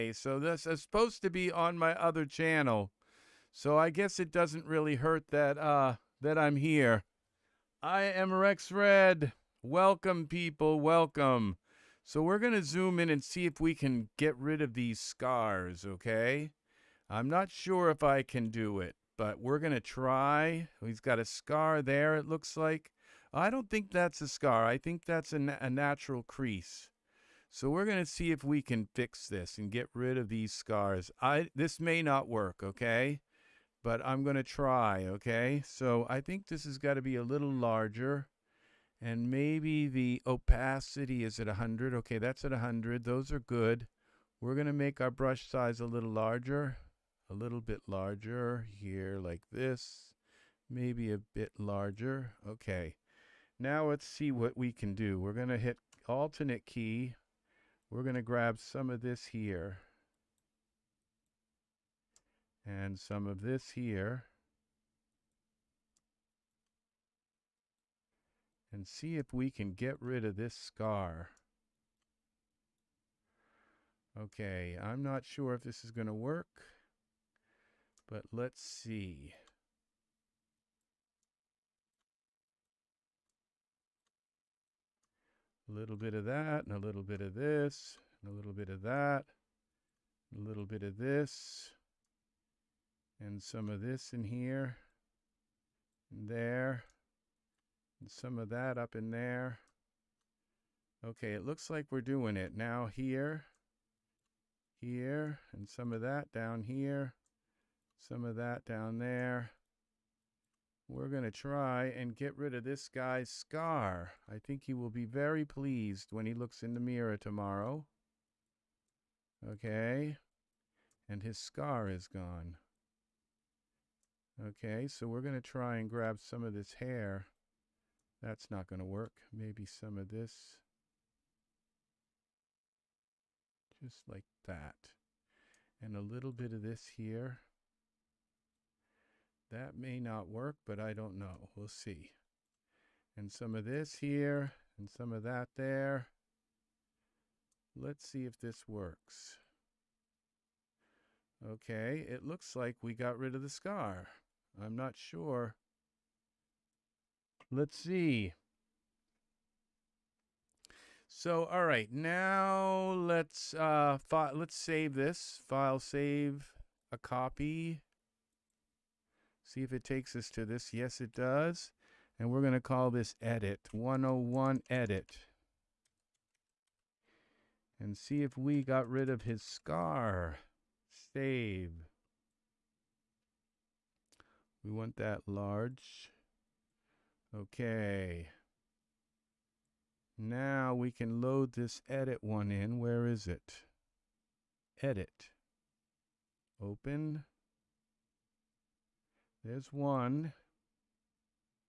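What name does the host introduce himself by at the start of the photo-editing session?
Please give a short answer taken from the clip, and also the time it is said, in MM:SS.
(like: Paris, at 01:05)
Rex Red, at 00:08.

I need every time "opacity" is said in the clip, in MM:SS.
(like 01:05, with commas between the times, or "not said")
00:40.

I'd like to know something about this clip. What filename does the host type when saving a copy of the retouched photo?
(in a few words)
101 edit.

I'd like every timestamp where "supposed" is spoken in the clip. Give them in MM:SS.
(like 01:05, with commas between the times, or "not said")
00:00.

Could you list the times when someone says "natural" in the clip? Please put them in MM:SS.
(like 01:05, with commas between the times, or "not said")
00:25.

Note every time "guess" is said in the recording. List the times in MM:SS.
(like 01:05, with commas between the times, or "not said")
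00:03.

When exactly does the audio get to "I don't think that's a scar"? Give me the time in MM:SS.
00:23.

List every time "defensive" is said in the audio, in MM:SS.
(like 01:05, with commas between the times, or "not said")
not said.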